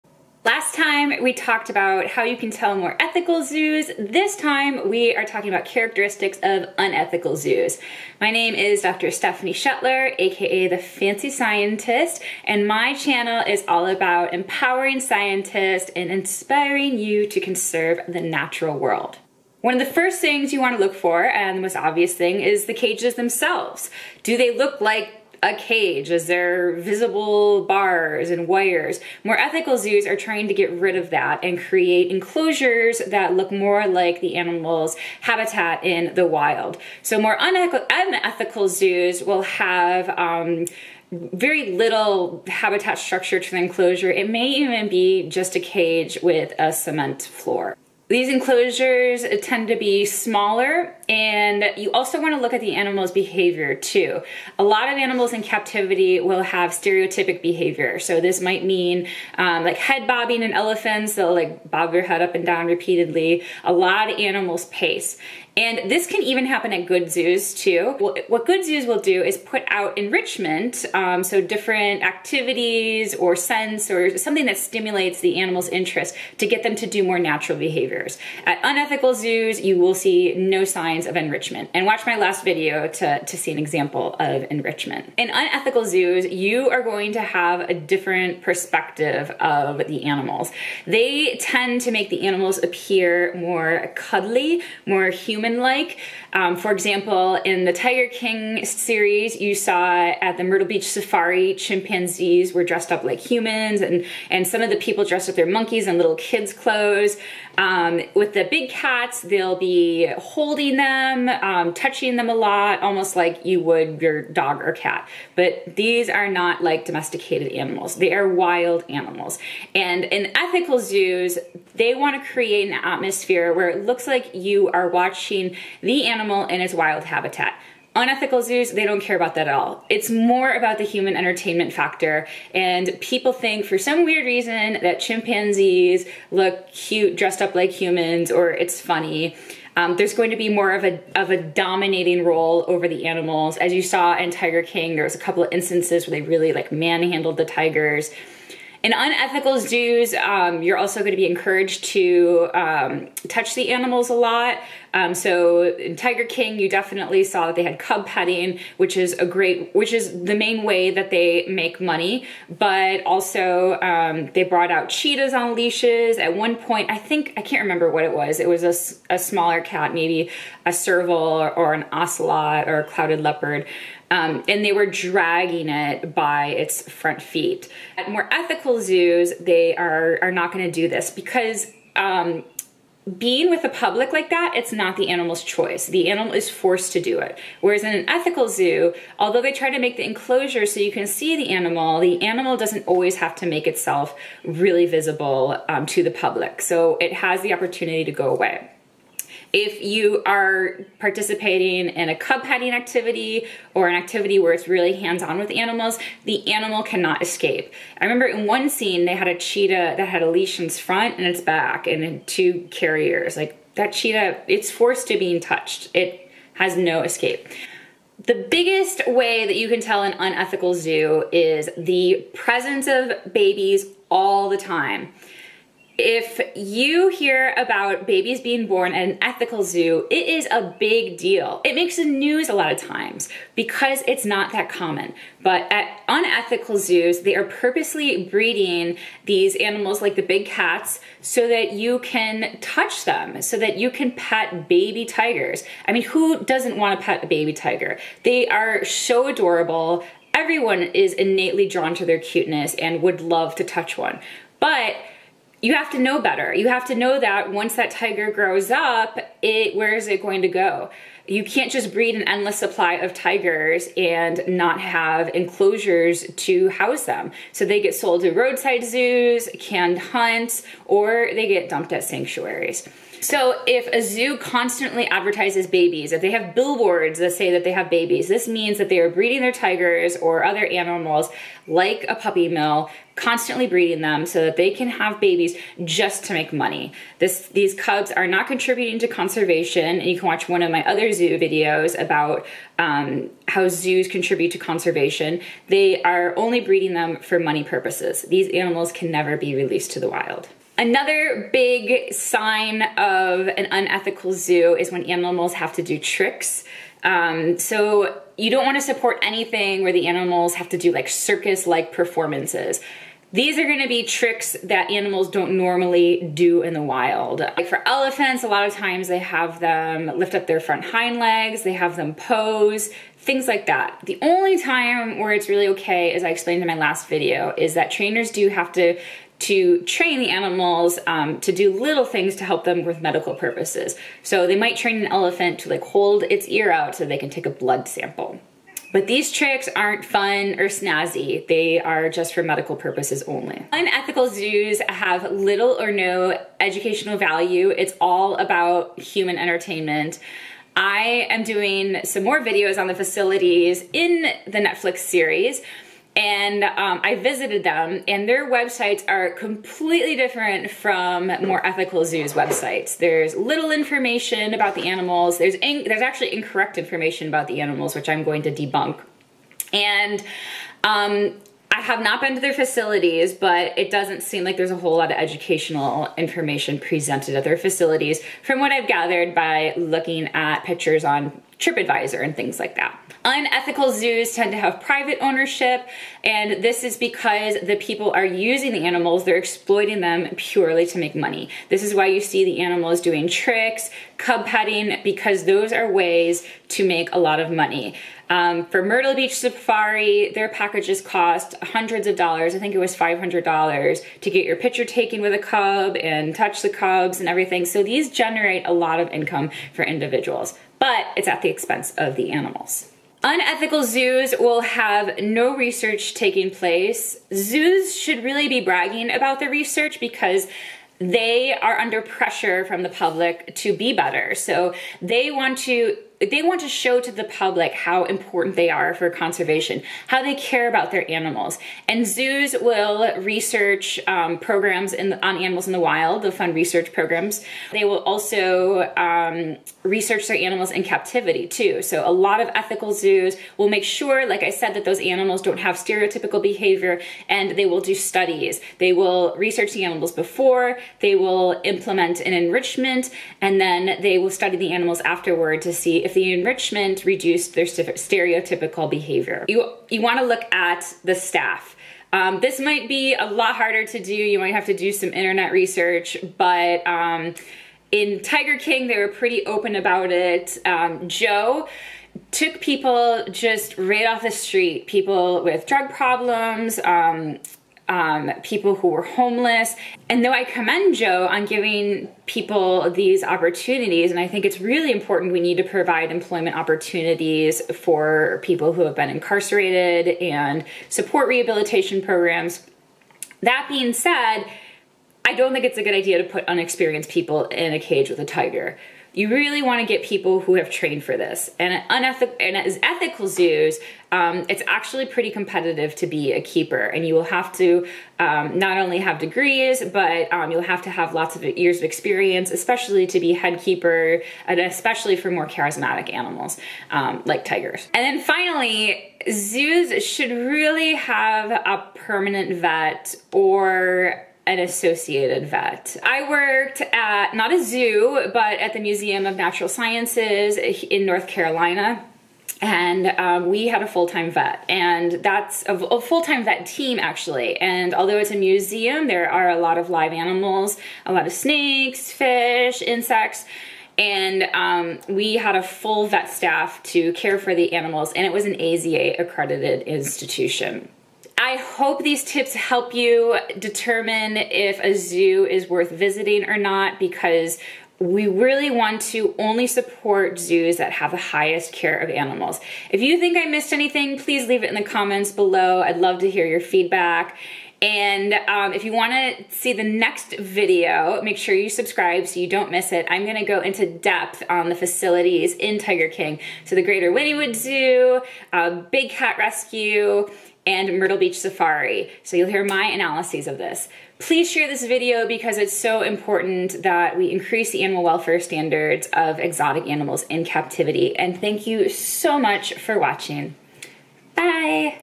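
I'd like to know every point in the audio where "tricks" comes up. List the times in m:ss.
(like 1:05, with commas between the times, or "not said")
5:05, 5:14, 5:39, 6:33.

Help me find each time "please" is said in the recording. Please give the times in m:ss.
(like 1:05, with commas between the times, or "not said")
9:24, 9:44.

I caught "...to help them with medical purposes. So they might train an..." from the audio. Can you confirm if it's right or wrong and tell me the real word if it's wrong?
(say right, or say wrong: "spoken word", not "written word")
right.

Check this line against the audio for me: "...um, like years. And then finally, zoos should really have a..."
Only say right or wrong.
wrong.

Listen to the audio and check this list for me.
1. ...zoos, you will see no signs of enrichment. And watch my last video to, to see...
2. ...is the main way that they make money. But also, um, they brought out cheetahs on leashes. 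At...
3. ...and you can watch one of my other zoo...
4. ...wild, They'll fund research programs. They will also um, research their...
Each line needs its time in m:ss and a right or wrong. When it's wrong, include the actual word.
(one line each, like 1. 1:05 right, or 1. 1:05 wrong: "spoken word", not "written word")
1. 1:19 right
2. 2:39 right
3. 4:49 right
4. 7:15 right.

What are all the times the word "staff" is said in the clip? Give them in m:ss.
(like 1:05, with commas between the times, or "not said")
7:41, 9:06.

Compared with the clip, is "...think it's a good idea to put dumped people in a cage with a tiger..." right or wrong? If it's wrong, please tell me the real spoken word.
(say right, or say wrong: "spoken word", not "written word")
wrong: "unexperienced", not "dumped".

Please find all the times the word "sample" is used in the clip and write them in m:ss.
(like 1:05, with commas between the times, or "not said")
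5:37.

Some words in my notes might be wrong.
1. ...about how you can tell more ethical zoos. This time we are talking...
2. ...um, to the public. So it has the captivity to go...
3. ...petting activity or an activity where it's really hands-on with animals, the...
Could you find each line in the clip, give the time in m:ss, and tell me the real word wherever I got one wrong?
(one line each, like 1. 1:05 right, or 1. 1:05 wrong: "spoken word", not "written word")
1. 0:01 right
2. 3:15 wrong: "opportunity", not "captivity"
3. 3:22 right.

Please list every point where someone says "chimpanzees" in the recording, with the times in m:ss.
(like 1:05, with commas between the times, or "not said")
1:41, 2:15.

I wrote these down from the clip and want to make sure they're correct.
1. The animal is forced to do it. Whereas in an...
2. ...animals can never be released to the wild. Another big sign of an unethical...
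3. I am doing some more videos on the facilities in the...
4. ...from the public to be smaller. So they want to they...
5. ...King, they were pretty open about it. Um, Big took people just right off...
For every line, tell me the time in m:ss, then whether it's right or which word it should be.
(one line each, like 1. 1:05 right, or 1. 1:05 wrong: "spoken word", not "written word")
1. 3:05 right
2. 4:58 right
3. 5:50 right
4. 7:02 wrong: "better", not "smaller"
5. 7:48 wrong: "Joe", not "Big".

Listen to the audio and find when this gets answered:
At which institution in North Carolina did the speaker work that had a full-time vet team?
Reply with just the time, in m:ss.
8:48.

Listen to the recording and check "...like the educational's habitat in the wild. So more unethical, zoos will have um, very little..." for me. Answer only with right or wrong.
wrong.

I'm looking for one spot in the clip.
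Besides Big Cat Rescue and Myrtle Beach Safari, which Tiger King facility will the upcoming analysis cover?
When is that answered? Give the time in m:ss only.
9:36.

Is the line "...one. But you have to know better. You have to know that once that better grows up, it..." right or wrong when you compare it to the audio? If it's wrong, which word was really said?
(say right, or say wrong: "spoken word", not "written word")
wrong: "tiger", not "better".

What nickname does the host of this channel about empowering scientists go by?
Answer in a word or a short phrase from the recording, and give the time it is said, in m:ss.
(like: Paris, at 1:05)
The Fancy Scientist, at 0:10.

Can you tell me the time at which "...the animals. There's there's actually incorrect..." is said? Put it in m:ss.
6:04.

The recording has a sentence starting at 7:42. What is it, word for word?
Um, this might be a lot harder to do.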